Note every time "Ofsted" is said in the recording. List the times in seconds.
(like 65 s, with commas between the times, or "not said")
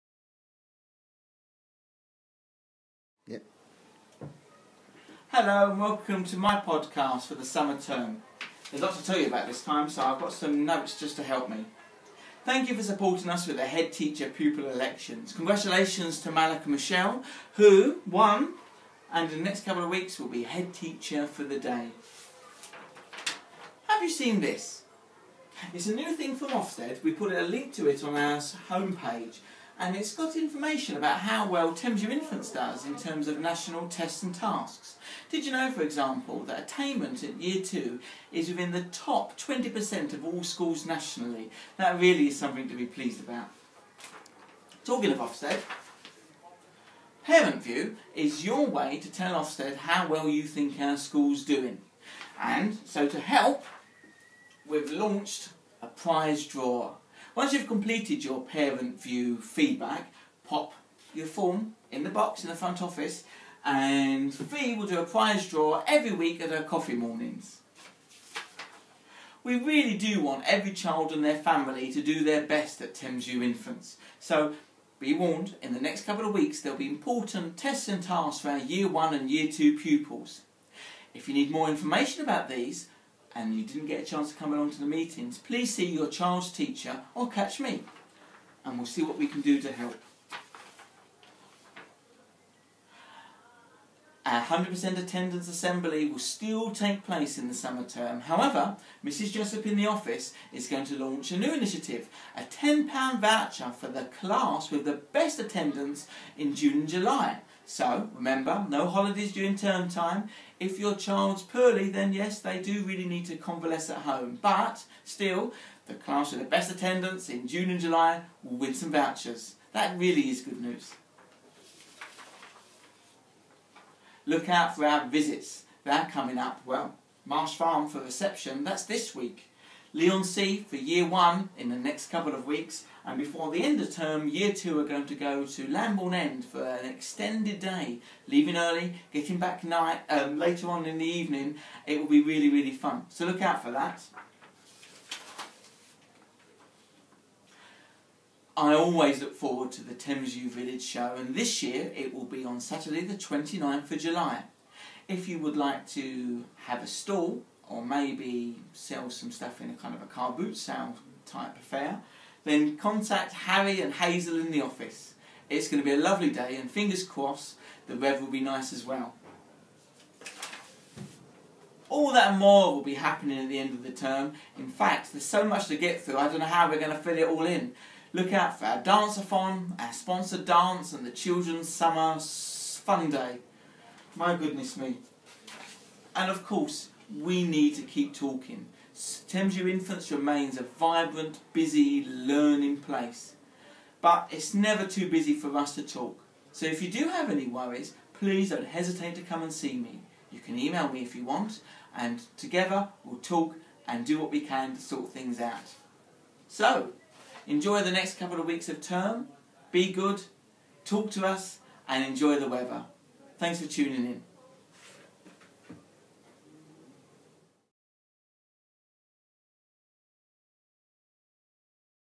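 26 s, 45 s, 49 s.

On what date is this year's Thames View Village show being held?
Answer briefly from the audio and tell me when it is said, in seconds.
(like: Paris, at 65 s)
Saturday 29th July, at 152 s.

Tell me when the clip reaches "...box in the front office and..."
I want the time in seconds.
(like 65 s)
62 s.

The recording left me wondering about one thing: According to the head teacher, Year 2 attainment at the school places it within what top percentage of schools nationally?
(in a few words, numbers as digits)
20%.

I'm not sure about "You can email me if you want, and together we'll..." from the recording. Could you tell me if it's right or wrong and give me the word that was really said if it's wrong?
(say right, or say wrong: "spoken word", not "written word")
right.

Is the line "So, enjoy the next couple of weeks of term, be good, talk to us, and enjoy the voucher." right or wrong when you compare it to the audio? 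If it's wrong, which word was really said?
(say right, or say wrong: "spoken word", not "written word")
wrong: "weather", not "voucher".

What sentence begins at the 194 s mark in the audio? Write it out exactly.
But it's never too busy for us to talk.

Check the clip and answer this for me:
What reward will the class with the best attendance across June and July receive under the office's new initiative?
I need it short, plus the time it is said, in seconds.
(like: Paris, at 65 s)
£10 voucher, at 102 s.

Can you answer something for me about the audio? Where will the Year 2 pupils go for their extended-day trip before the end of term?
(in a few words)
Lambourne End.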